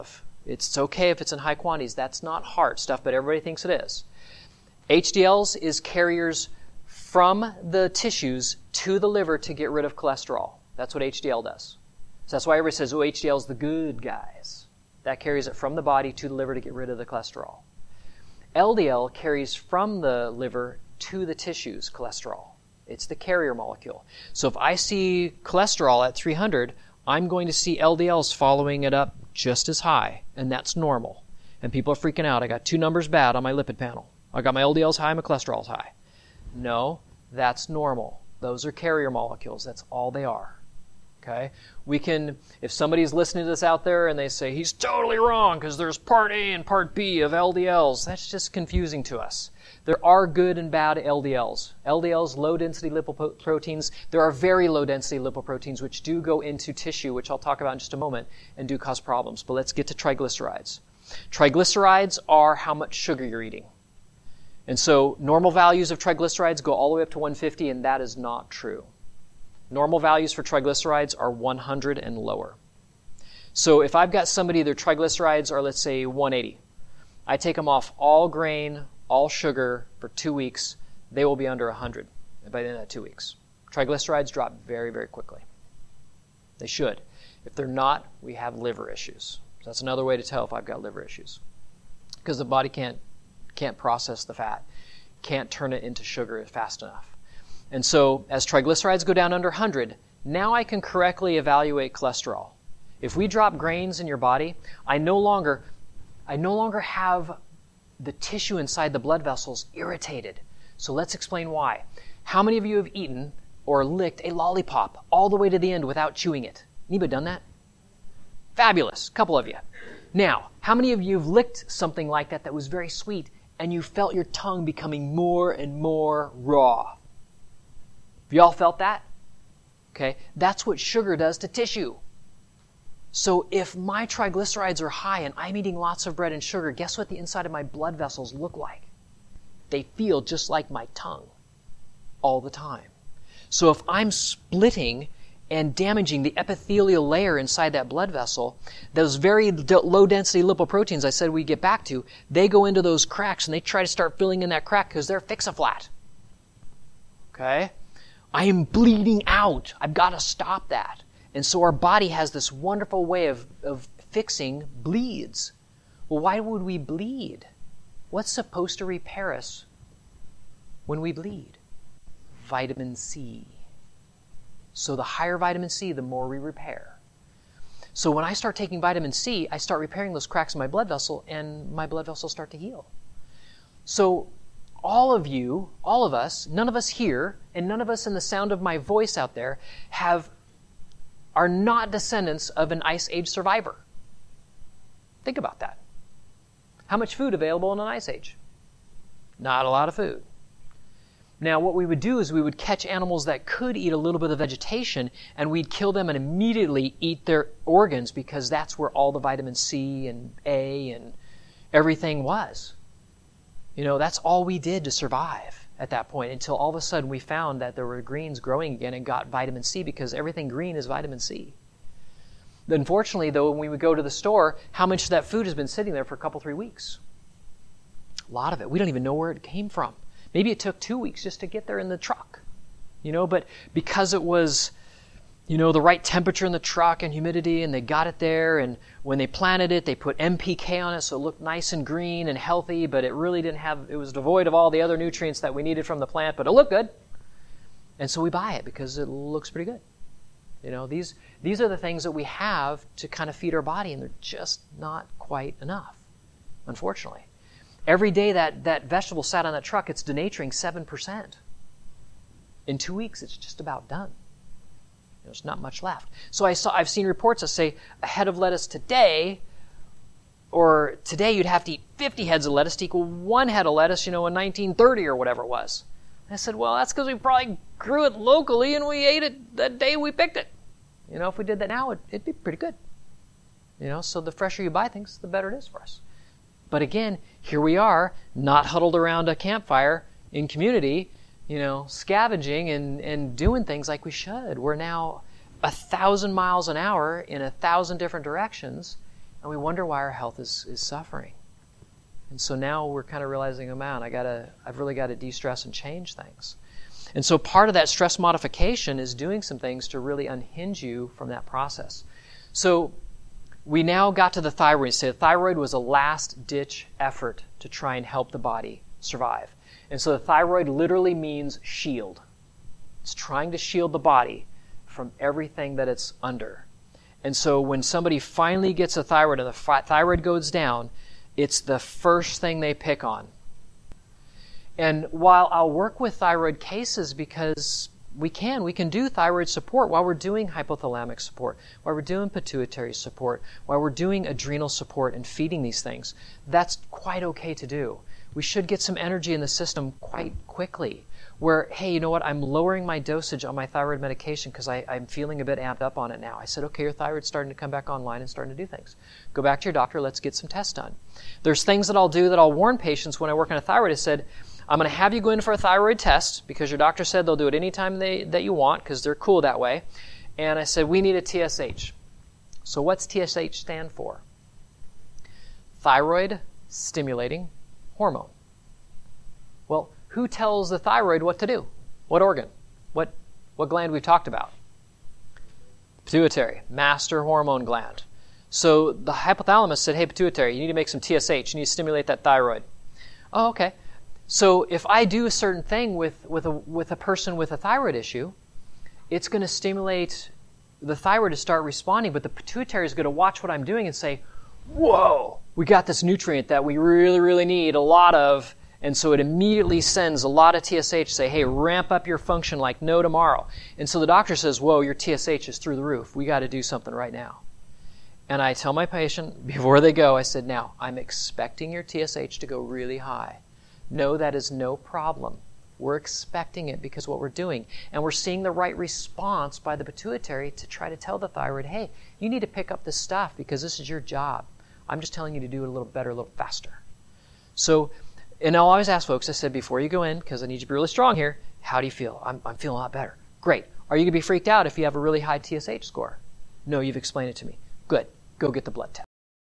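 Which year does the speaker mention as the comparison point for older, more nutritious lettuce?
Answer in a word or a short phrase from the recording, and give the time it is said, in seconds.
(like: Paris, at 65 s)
1930, at 274 s.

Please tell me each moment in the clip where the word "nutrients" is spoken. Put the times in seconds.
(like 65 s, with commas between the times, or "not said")
244 s, 406 s.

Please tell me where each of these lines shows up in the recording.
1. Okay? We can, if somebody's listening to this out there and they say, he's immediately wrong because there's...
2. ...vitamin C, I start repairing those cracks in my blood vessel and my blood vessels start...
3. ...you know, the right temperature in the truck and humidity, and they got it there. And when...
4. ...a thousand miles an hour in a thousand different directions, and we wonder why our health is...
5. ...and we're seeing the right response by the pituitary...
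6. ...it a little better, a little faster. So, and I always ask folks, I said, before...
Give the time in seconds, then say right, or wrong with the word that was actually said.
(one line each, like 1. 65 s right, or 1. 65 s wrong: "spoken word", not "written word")
1. 41 s wrong: "totally", not "immediately"
2. 178 s right
3. 235 s right
4. 295 s right
5. 427 s right
6. 435 s right.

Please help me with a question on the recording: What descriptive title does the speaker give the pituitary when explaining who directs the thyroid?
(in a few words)
Master hormone gland.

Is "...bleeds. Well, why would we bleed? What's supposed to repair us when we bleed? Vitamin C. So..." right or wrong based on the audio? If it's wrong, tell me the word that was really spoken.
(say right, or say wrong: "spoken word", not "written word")
right.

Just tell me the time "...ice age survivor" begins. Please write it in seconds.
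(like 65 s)
192 s.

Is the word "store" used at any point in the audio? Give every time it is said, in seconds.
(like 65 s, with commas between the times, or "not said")
224 s.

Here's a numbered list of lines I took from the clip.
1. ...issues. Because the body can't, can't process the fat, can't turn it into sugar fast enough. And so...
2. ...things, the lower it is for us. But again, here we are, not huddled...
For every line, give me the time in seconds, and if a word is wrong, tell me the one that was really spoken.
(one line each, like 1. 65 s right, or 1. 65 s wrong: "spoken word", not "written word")
1. 91 s right
2. 284 s wrong: "better", not "lower".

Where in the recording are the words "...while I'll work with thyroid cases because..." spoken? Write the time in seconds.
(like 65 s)
335 s.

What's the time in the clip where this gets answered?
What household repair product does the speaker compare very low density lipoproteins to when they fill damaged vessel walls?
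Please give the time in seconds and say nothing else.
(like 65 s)
155 s.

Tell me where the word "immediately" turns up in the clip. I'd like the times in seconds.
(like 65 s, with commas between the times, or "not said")
206 s, 409 s.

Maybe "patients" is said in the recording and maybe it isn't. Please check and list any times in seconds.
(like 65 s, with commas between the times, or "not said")
362 s, 418 s.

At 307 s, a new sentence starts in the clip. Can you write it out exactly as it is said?
And so part of that stress modification is doing some things to really unhinge you from that process.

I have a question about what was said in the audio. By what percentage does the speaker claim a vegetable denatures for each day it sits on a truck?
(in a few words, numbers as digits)
7%.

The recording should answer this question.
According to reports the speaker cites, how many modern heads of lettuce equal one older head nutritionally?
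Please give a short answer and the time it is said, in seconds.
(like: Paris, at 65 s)
50, at 271 s.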